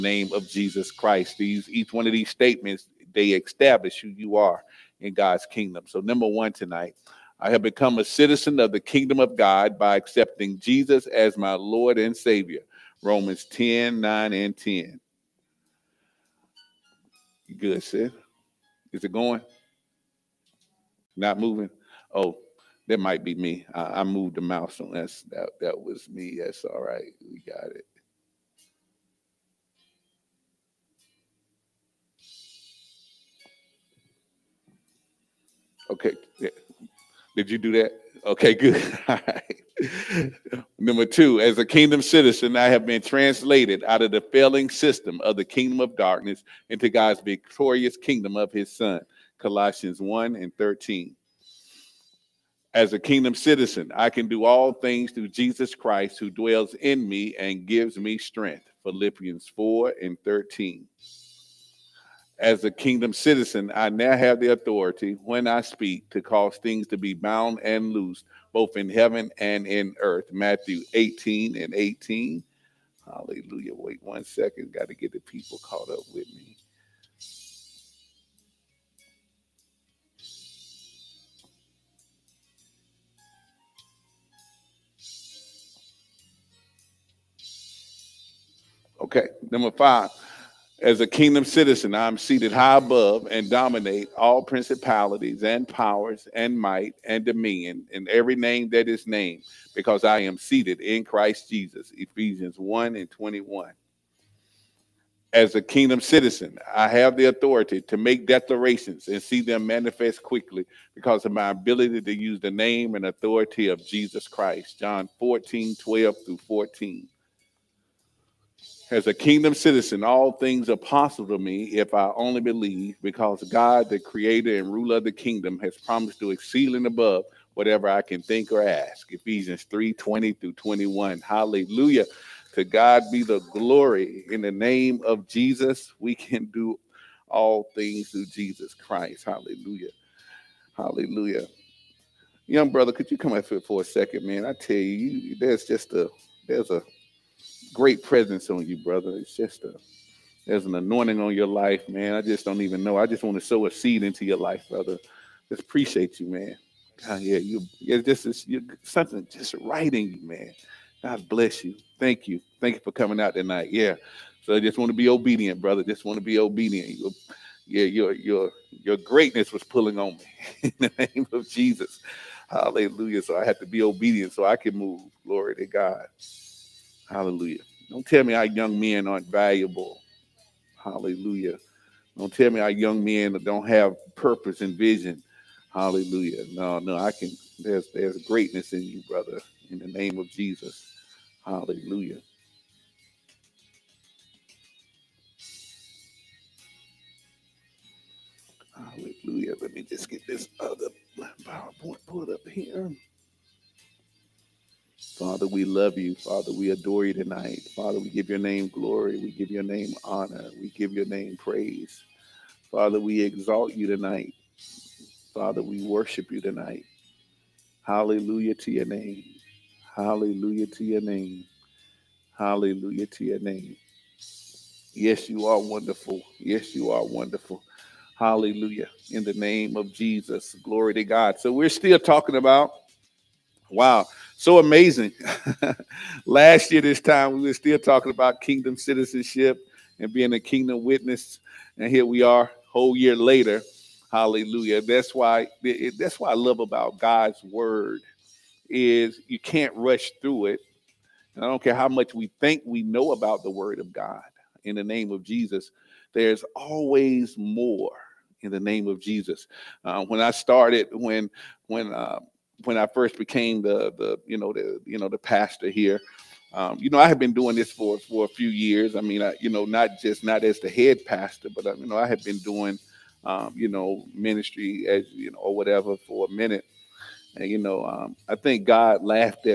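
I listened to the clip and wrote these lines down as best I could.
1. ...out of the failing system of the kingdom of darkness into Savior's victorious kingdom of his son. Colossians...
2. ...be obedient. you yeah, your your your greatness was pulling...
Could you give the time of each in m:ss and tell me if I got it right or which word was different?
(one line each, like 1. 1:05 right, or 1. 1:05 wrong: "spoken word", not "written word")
1. 0:43 wrong: "God", not "Savior"
2. 2:46 right.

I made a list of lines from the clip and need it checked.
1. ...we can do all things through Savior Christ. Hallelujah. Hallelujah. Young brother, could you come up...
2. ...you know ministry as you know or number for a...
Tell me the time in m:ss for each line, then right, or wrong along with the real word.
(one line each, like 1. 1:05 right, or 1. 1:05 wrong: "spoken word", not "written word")
1. 2:15 wrong: "Jesus", not "Savior"
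2. 4:33 wrong: "whatever", not "number".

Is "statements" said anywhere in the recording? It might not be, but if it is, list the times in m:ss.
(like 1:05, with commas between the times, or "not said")
0:02.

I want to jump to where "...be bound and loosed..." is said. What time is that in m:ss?
1:06.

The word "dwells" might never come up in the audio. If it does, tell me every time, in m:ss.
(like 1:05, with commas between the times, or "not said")
0:56.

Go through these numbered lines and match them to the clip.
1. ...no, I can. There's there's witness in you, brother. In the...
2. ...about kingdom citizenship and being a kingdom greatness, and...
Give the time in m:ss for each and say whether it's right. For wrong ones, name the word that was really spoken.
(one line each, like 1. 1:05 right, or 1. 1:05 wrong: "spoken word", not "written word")
1. 3:06 wrong: "greatness", not "witness"
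2. 3:58 wrong: "witness", not "greatness".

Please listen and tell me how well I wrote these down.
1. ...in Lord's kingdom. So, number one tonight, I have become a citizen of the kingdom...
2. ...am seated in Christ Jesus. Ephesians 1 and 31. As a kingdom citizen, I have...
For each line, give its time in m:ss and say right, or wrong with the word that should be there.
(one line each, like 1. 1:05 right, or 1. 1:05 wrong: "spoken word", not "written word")
1. 0:04 wrong: "God", not "Lord"
2. 1:40 wrong: "21", not "31".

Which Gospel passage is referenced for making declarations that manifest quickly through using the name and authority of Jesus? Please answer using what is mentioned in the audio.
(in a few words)
John 14:12-14.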